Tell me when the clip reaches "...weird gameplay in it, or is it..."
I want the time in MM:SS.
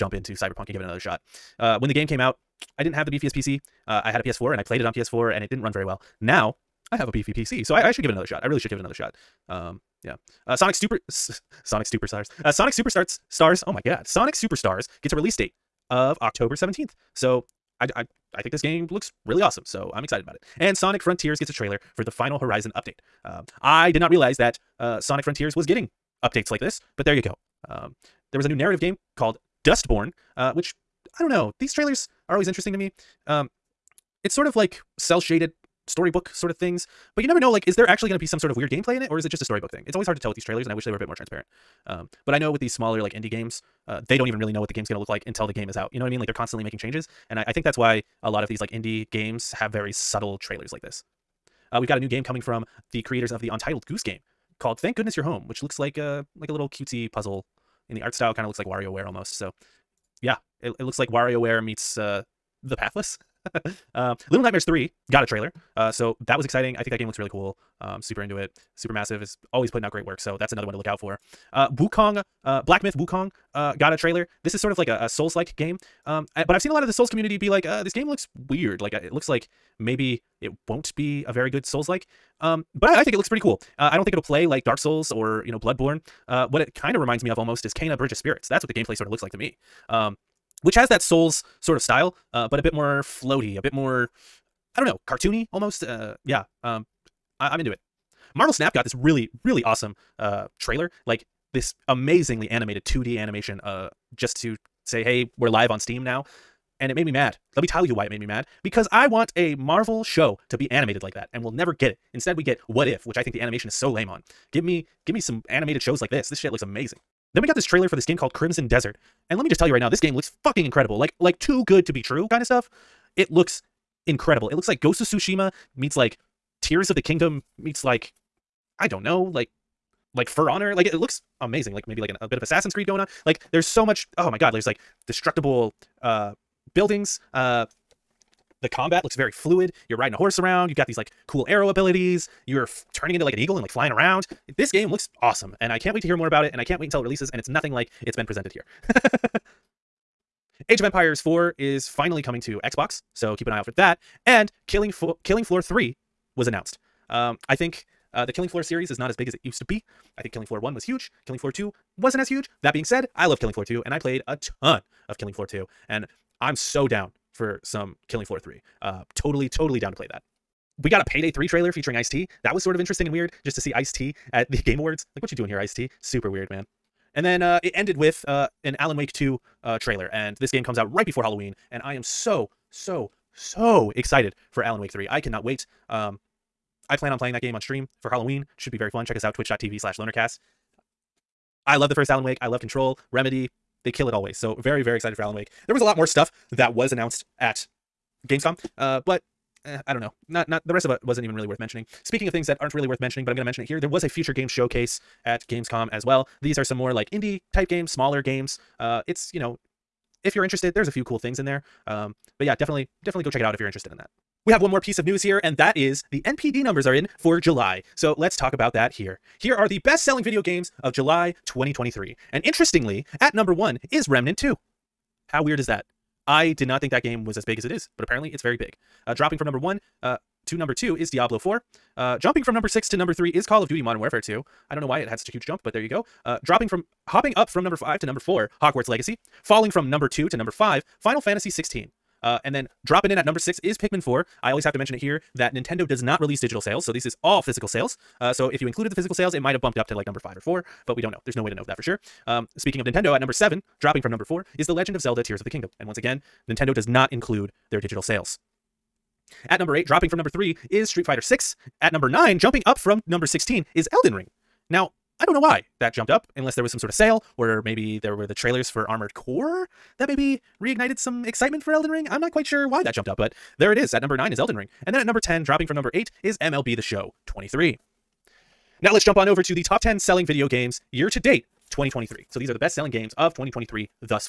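00:38.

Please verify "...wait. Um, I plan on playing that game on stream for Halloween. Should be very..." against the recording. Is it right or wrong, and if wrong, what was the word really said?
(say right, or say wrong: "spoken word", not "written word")
right.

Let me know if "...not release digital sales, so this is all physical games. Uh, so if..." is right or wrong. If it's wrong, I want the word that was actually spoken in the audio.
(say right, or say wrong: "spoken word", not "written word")
wrong: "sales", not "games".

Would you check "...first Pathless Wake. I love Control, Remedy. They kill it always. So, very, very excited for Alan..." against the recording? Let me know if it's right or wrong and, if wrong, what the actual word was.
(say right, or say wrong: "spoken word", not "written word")
wrong: "Alan", not "Pathless".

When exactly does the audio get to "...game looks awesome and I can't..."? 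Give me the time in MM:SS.
02:24.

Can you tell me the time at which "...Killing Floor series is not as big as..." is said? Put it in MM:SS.
02:38.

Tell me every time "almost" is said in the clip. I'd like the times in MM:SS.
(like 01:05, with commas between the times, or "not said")
00:59, 01:27, 01:35.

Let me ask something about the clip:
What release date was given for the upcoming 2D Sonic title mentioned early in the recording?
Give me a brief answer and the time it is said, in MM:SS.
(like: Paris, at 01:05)
October 17th, at 00:16.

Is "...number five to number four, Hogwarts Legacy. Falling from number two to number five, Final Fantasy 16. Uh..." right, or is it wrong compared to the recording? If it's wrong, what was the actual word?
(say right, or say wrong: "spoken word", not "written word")
right.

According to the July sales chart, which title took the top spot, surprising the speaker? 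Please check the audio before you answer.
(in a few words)
Remnant 2.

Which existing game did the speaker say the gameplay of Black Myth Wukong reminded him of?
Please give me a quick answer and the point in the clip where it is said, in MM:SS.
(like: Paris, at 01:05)
Kena Bridge of Spirits, at 01:27.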